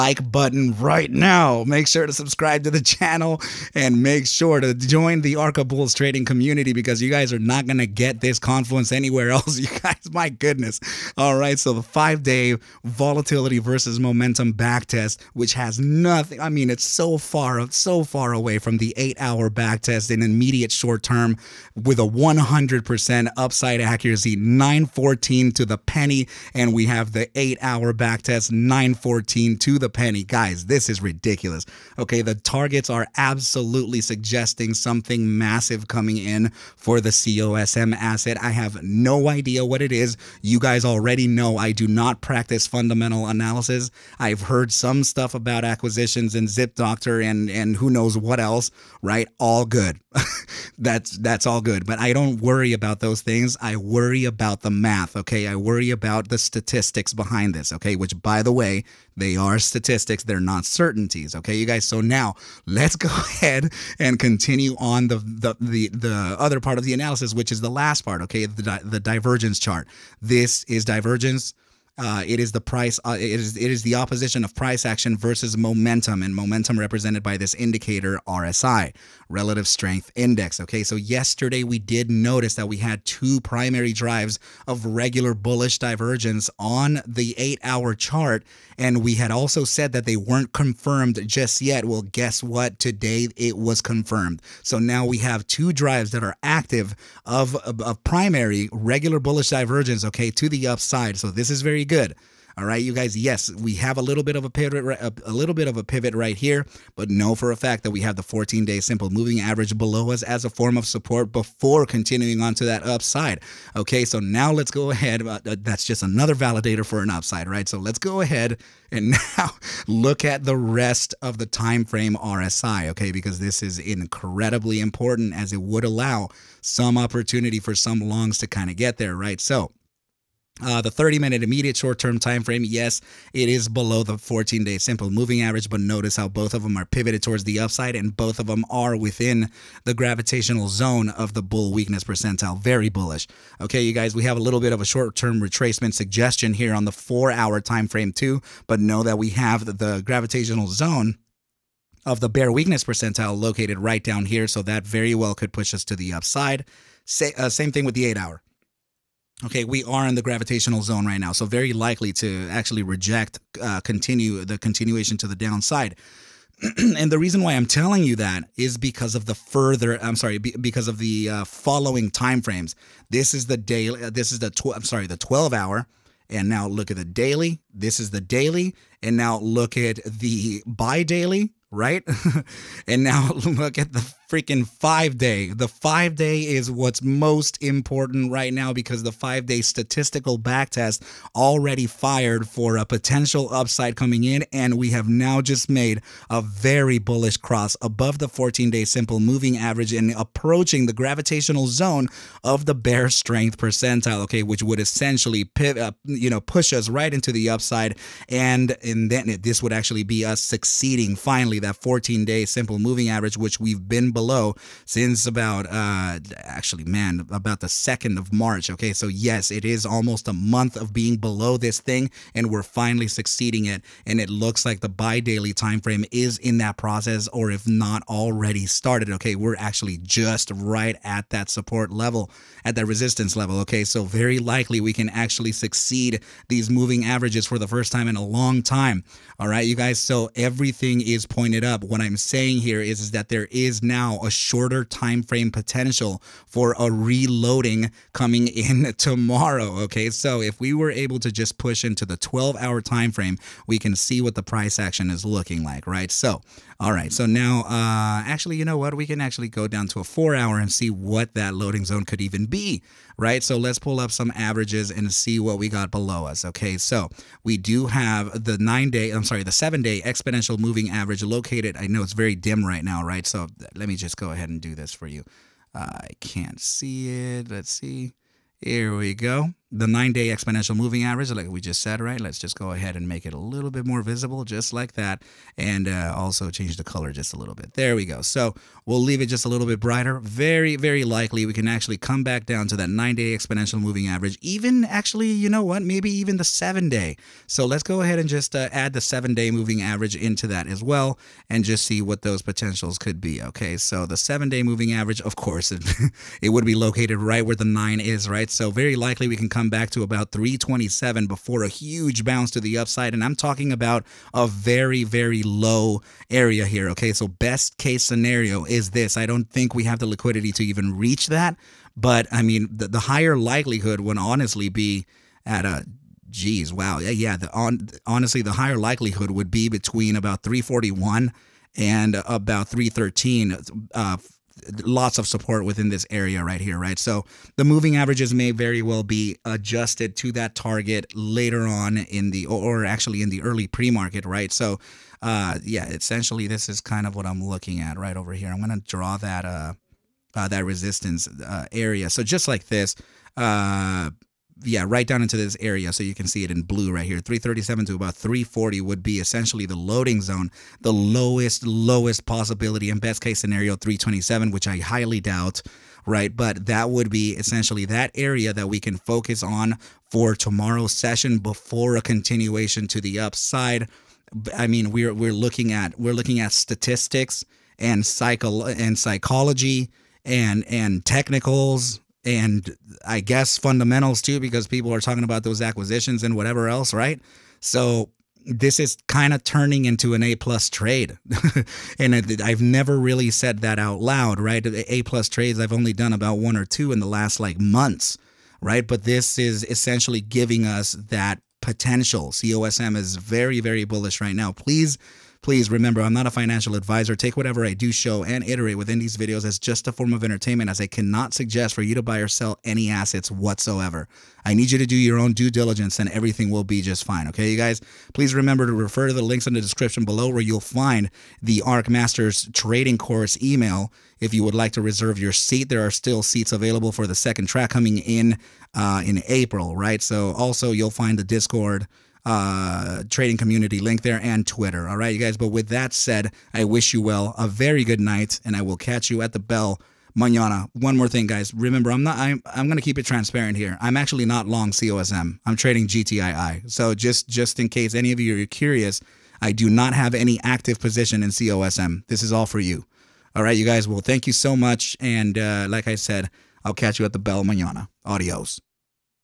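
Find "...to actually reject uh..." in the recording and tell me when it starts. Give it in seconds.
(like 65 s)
162 s.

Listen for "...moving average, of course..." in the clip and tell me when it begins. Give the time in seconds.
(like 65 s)
304 s.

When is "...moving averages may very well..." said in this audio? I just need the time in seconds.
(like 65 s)
337 s.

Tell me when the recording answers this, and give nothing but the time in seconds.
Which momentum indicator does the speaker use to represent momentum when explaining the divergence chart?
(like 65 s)
79 s.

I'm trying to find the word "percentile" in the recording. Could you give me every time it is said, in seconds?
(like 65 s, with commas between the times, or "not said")
142 s, 152 s, 203 s.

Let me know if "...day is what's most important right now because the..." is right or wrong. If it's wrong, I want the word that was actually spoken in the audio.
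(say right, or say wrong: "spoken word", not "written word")
right.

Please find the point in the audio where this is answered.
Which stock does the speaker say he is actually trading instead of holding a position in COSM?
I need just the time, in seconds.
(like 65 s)
445 s.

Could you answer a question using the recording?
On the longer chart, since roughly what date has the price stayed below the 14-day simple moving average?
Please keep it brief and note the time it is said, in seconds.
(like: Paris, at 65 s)
2nd of March, at 217 s.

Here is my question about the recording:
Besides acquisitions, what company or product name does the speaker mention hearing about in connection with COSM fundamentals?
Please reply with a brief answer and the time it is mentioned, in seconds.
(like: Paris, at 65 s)
Zip Doctor, at 46 s.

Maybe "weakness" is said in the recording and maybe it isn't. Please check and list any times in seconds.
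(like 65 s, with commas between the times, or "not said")
141 s, 152 s.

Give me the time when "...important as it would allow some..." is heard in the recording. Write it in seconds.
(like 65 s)
124 s.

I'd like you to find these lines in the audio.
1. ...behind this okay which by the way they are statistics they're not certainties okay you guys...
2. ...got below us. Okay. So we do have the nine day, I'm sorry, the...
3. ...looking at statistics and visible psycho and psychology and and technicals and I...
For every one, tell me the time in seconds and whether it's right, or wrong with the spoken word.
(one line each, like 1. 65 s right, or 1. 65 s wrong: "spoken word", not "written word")
1. 57 s right
2. 265 s right
3. 376 s wrong: "cycle", not "visible".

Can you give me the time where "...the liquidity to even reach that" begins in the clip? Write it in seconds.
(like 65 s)
319 s.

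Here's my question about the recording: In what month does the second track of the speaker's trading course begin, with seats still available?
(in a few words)
April.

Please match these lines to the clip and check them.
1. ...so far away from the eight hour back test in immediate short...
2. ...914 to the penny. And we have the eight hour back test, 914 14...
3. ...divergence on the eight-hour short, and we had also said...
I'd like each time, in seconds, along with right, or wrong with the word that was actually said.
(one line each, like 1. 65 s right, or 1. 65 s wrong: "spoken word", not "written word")
1. 17 s right
2. 24 s right
3. 85 s wrong: "chart", not "short".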